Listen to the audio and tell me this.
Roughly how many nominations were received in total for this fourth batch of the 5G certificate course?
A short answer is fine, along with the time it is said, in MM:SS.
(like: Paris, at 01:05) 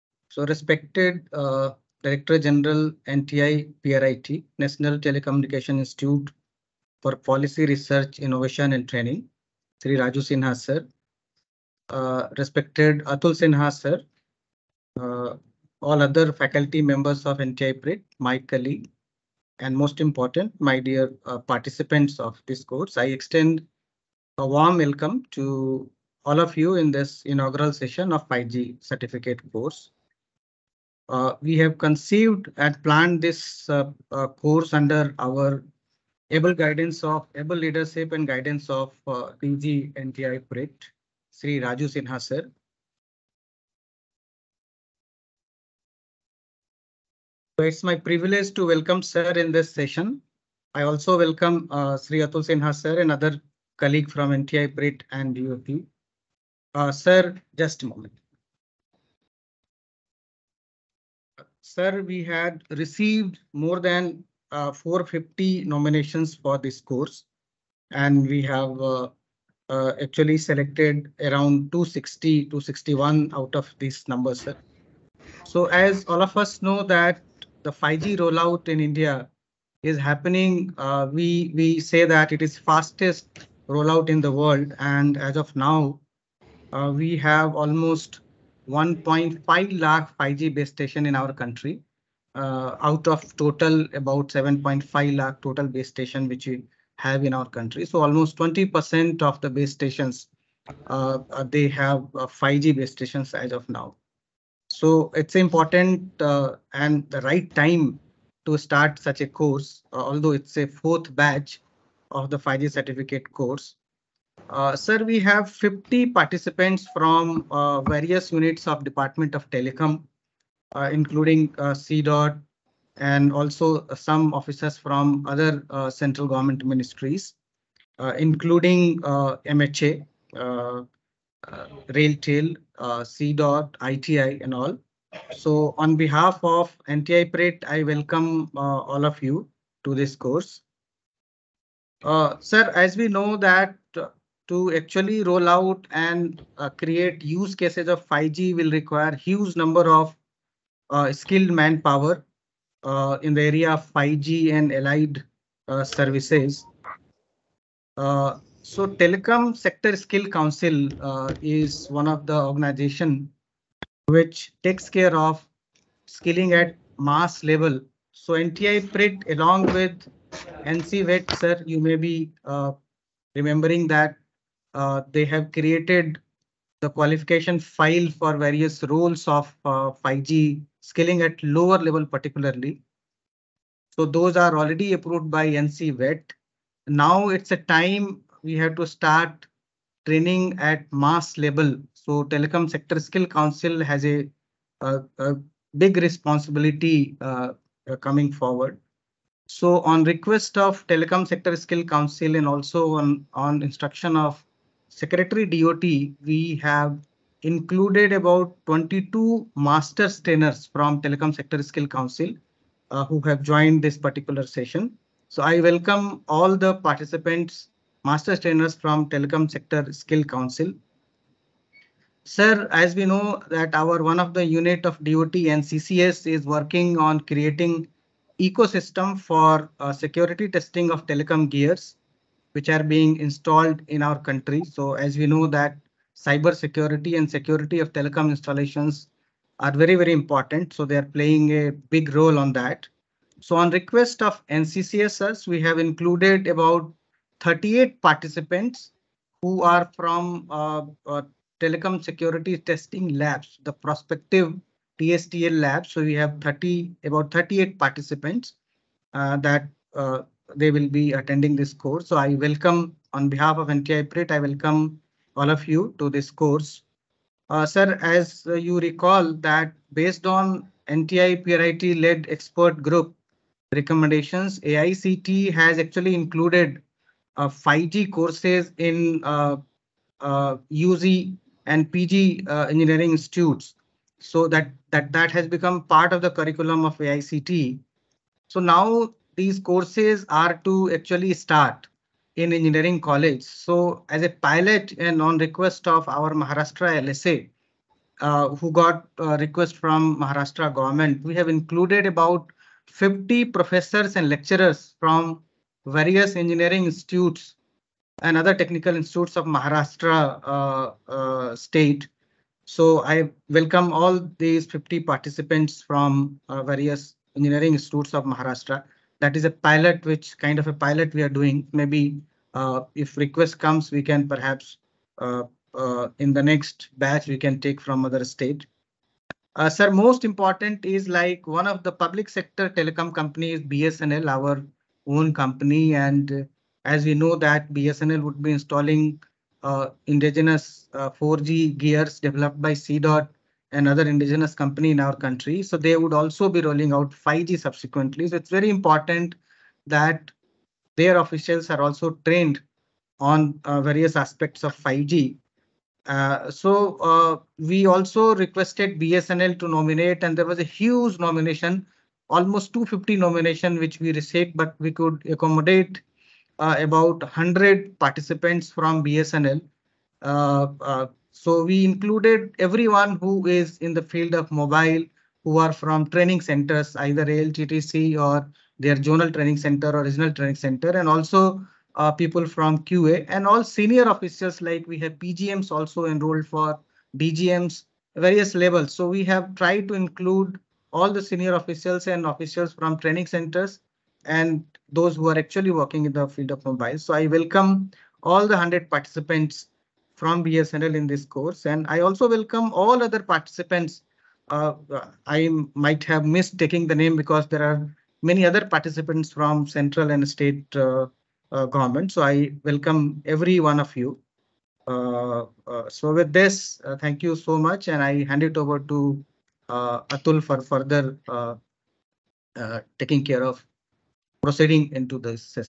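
more than 450, at 01:03.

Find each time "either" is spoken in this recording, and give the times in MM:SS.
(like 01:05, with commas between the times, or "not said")
06:16.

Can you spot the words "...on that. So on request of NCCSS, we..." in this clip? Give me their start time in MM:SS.
04:02.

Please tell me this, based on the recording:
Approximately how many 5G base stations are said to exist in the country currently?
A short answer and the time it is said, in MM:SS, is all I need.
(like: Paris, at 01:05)
1.5 lakh, at 01:28.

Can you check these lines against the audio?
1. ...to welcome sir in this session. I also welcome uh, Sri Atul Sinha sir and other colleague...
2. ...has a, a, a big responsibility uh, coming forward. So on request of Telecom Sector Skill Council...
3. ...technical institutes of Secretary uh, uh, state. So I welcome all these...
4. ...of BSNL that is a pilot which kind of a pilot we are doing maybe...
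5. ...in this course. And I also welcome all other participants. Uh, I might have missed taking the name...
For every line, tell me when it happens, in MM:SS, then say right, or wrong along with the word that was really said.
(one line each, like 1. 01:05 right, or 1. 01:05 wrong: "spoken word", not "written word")
1. 00:48 right
2. 03:13 right
3. 05:08 wrong: "Maharashtra", not "Secretary"
4. 05:18 wrong: "Maharashtra", not "BSNL"
5. 06:40 right.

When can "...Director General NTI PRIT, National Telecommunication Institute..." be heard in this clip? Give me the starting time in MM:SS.
00:02.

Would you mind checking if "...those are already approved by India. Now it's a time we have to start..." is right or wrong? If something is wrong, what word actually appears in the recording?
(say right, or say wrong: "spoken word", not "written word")
wrong: "VET", not "India".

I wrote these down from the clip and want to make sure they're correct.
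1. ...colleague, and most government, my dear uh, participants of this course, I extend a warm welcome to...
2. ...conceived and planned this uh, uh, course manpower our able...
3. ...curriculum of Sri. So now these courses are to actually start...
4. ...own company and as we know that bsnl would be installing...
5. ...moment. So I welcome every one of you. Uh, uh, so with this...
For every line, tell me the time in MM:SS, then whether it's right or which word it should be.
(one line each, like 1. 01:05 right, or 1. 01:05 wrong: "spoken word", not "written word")
1. 00:18 wrong: "important", not "government"
2. 00:31 wrong: "under", not "manpower"
3. 04:46 wrong: "AICTE", not "Sri"
4. 05:35 right
5. 06:51 wrong: "government", not "moment".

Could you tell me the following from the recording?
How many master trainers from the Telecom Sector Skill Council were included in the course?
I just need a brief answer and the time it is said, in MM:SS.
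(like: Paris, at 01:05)
22, at 03:28.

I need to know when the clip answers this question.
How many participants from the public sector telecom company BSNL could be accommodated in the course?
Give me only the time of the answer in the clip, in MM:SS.
06:06.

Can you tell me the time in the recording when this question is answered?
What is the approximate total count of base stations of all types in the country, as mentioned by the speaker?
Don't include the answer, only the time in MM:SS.
01:34.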